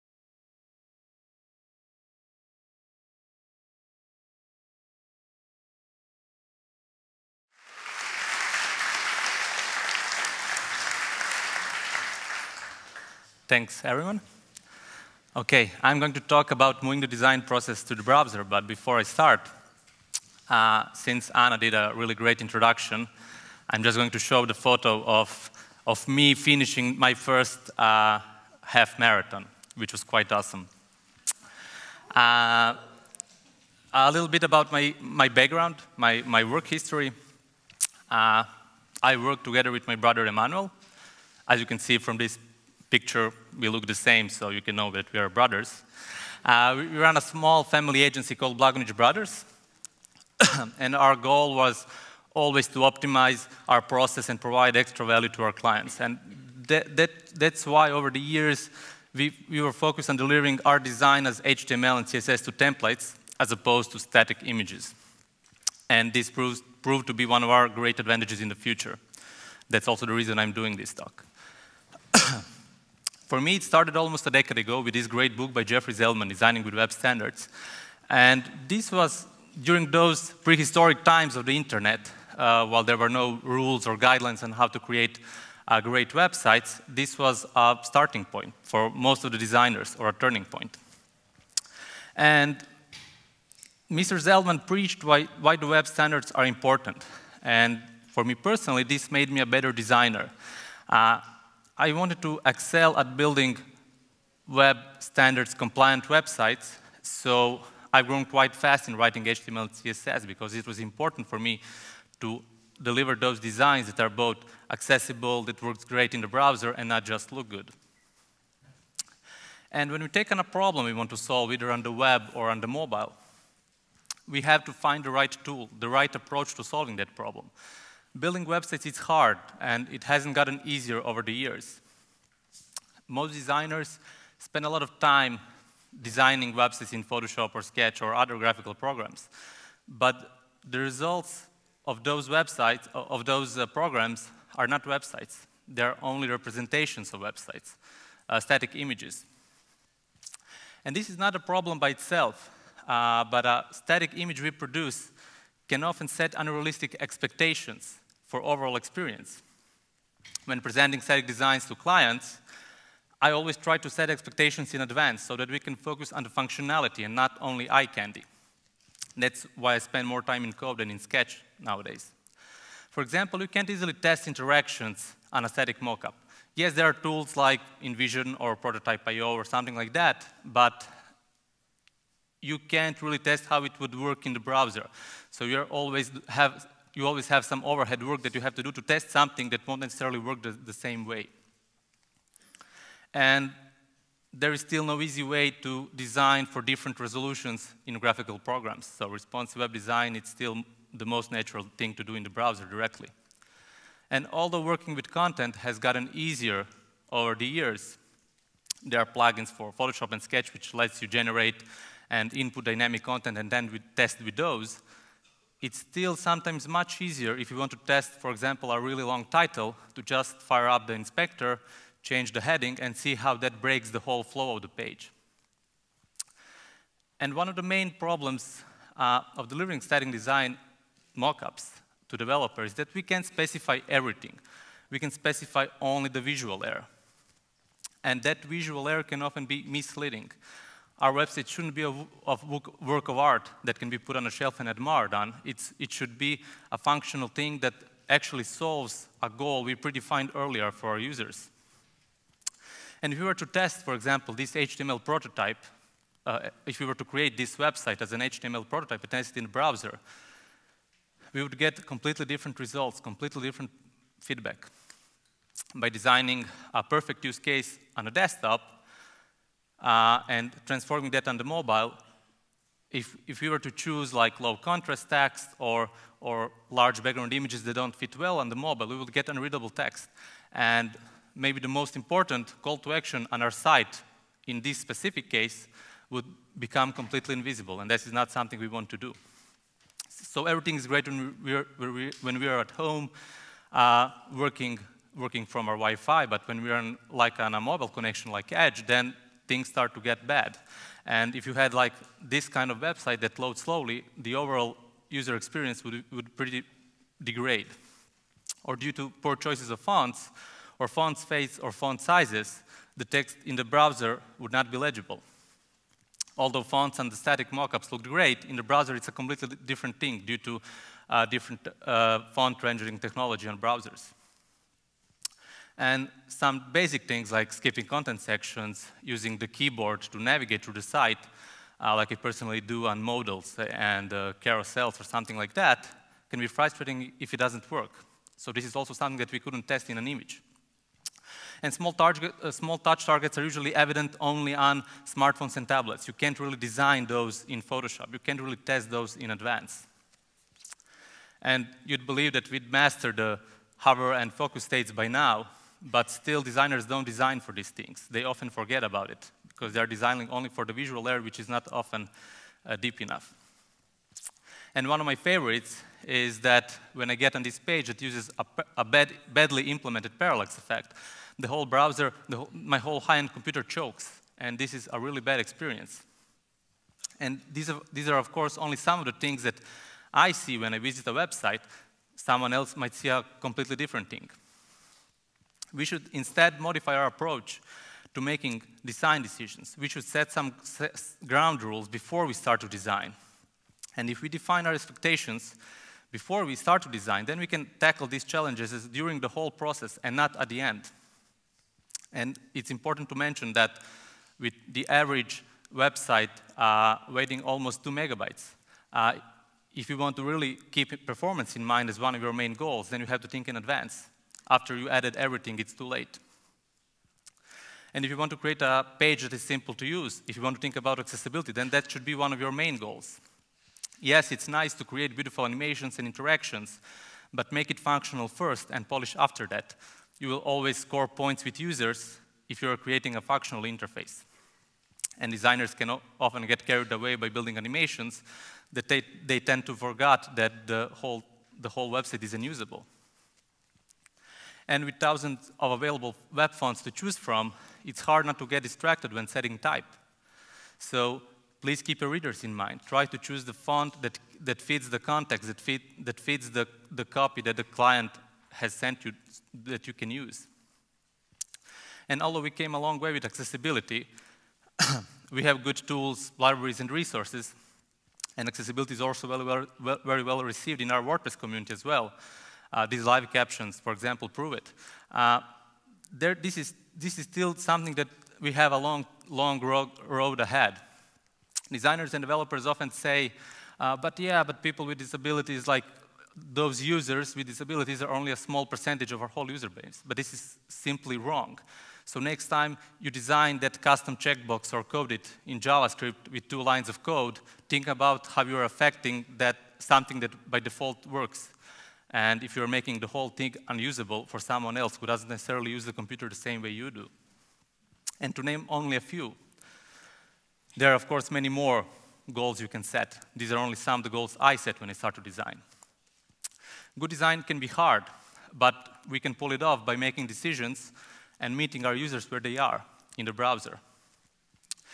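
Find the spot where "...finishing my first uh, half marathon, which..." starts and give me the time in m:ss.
0:26.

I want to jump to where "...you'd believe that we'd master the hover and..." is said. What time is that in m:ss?
5:51.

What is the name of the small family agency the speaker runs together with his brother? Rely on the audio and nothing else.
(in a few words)
Blagonić Brothers.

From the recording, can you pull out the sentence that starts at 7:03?
Yes, it's nice to create beautiful animations and interactions, but make it functional first and polish after that.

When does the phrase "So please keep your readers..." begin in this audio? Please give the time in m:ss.
7:30.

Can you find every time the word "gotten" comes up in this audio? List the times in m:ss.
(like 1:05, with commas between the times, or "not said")
2:10, 3:25.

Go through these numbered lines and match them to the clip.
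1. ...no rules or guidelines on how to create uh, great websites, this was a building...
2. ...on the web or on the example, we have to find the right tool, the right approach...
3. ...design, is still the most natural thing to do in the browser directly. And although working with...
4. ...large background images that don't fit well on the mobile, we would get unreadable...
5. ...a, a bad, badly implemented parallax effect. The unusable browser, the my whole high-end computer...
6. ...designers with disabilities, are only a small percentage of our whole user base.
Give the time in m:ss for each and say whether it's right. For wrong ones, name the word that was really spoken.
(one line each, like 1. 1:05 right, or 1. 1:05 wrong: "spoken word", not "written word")
1. 1:23 wrong: "starting", not "building"
2. 2:01 wrong: "mobile", not "example"
3. 3:19 right
4. 4:36 right
5. 6:08 wrong: "whole", not "unusable"
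6. 8:06 wrong: "users", not "designers".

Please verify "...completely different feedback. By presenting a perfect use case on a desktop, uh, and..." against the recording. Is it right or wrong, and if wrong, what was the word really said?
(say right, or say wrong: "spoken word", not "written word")
wrong: "designing", not "presenting".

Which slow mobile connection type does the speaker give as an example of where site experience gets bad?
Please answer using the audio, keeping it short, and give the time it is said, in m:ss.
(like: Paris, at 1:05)
Edge, at 4:58.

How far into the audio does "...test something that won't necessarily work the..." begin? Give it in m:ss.
3:08.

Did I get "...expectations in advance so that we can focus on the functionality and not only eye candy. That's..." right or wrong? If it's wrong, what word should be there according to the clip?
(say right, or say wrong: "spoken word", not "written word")
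right.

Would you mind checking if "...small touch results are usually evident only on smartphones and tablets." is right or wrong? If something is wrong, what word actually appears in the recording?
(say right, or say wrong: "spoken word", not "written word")
wrong: "targets", not "results".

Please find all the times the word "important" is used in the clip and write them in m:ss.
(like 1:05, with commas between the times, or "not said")
1:36, 1:50, 4:41, 6:42.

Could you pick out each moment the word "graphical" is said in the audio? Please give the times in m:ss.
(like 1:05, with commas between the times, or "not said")
2:18, 3:17.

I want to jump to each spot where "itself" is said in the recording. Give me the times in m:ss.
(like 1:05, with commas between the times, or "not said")
2:31.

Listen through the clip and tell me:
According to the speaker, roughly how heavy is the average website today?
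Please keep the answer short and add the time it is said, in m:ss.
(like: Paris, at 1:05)
2 megabytes, at 6:47.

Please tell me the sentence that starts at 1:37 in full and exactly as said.
And for me personally, this made me a better designer.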